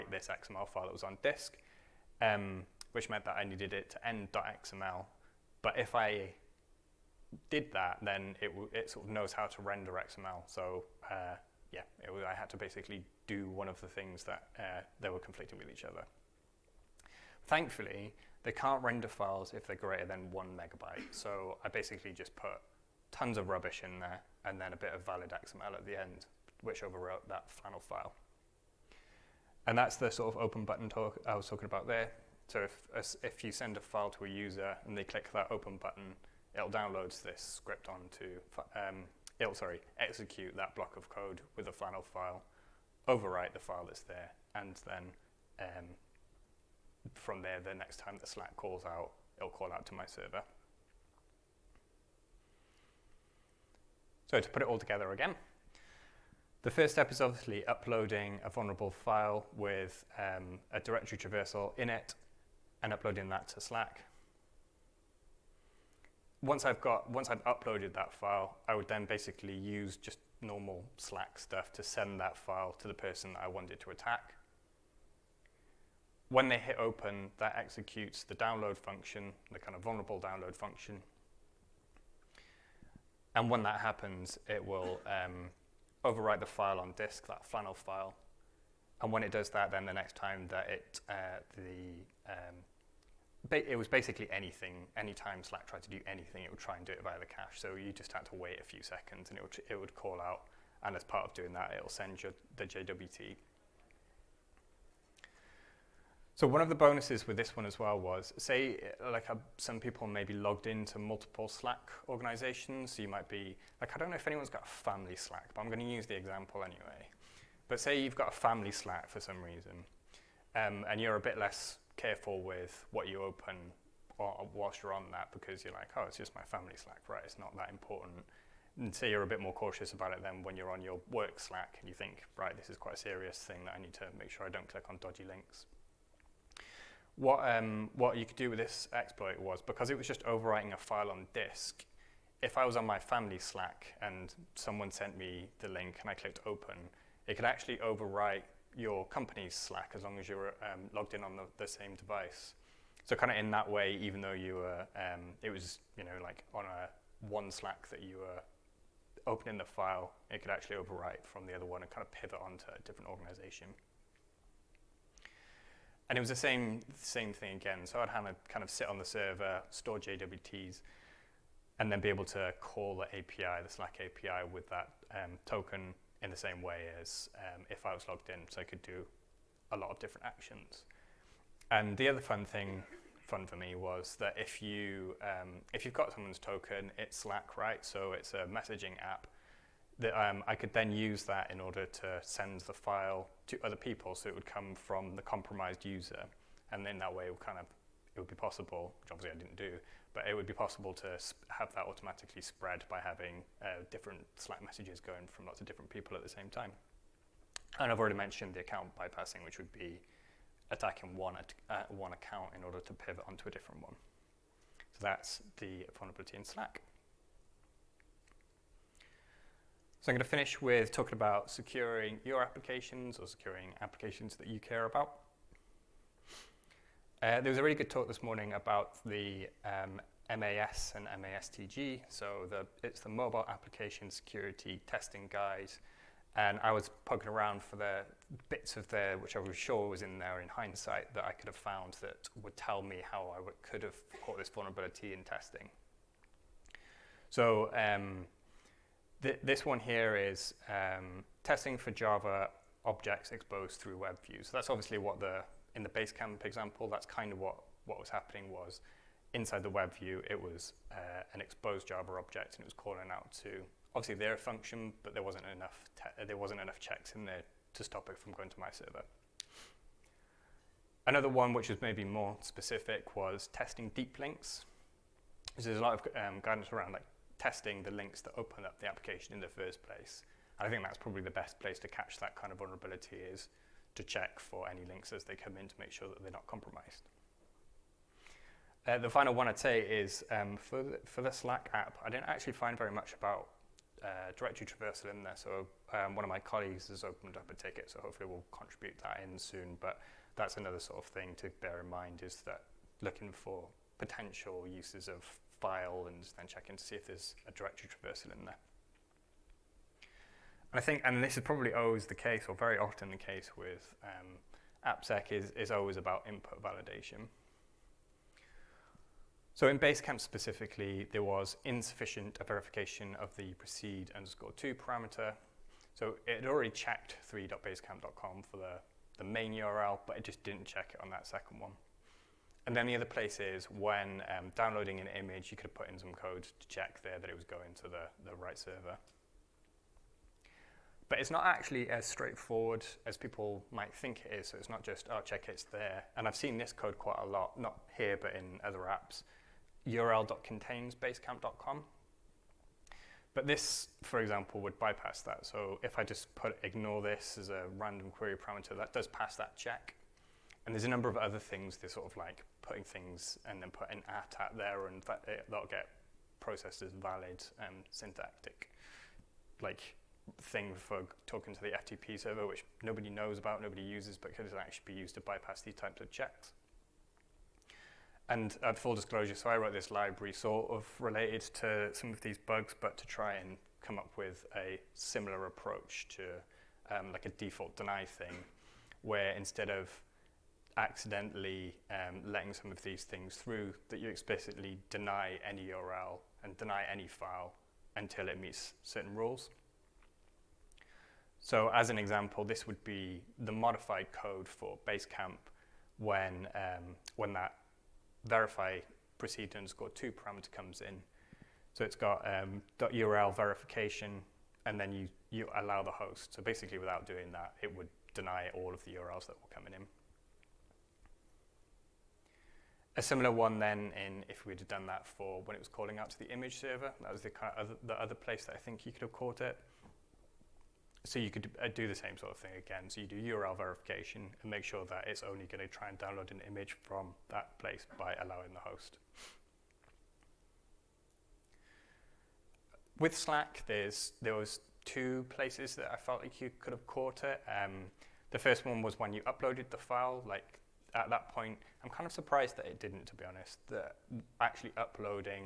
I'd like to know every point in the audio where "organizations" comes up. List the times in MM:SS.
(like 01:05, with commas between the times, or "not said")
01:52, 02:43.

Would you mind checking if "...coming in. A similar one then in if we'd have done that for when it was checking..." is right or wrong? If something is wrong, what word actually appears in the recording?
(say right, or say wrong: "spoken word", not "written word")
wrong: "calling", not "checking".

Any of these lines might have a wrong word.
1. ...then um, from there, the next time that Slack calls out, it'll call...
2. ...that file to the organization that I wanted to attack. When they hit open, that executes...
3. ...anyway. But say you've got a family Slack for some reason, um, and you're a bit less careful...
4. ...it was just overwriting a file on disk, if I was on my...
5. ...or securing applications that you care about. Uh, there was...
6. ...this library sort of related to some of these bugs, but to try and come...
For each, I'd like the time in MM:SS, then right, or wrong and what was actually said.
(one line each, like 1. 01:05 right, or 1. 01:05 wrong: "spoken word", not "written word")
1. 00:44 right
2. 01:12 wrong: "person", not "organization"
3. 01:56 right
4. 02:19 right
5. 03:43 right
6. 06:19 right.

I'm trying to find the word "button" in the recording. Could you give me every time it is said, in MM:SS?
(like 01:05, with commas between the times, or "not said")
00:30, 00:35.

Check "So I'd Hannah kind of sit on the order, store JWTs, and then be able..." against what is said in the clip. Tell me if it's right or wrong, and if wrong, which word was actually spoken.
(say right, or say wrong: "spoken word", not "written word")
wrong: "server", not "order".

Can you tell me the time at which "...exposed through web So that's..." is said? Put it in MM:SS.
04:13.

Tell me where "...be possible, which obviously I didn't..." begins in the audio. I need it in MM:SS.
03:18.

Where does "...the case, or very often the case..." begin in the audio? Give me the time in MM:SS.
05:12.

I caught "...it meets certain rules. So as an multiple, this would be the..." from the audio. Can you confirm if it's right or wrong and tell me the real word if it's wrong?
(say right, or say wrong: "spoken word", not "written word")
wrong: "example", not "multiple".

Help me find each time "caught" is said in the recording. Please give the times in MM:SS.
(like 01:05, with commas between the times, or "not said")
04:04, 07:09, 07:26.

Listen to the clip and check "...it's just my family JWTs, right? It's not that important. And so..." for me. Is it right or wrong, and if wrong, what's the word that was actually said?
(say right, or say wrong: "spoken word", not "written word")
wrong: "Slack", not "JWTs".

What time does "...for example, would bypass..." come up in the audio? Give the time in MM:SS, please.
05:54.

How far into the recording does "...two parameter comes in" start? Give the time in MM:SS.
06:49.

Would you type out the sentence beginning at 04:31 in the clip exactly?
Another one which was maybe more specific was testing deep links.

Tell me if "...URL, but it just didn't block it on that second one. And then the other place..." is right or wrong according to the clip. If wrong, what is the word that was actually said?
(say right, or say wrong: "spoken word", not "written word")
wrong: "check", not "block".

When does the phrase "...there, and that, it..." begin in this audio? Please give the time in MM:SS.
06:04.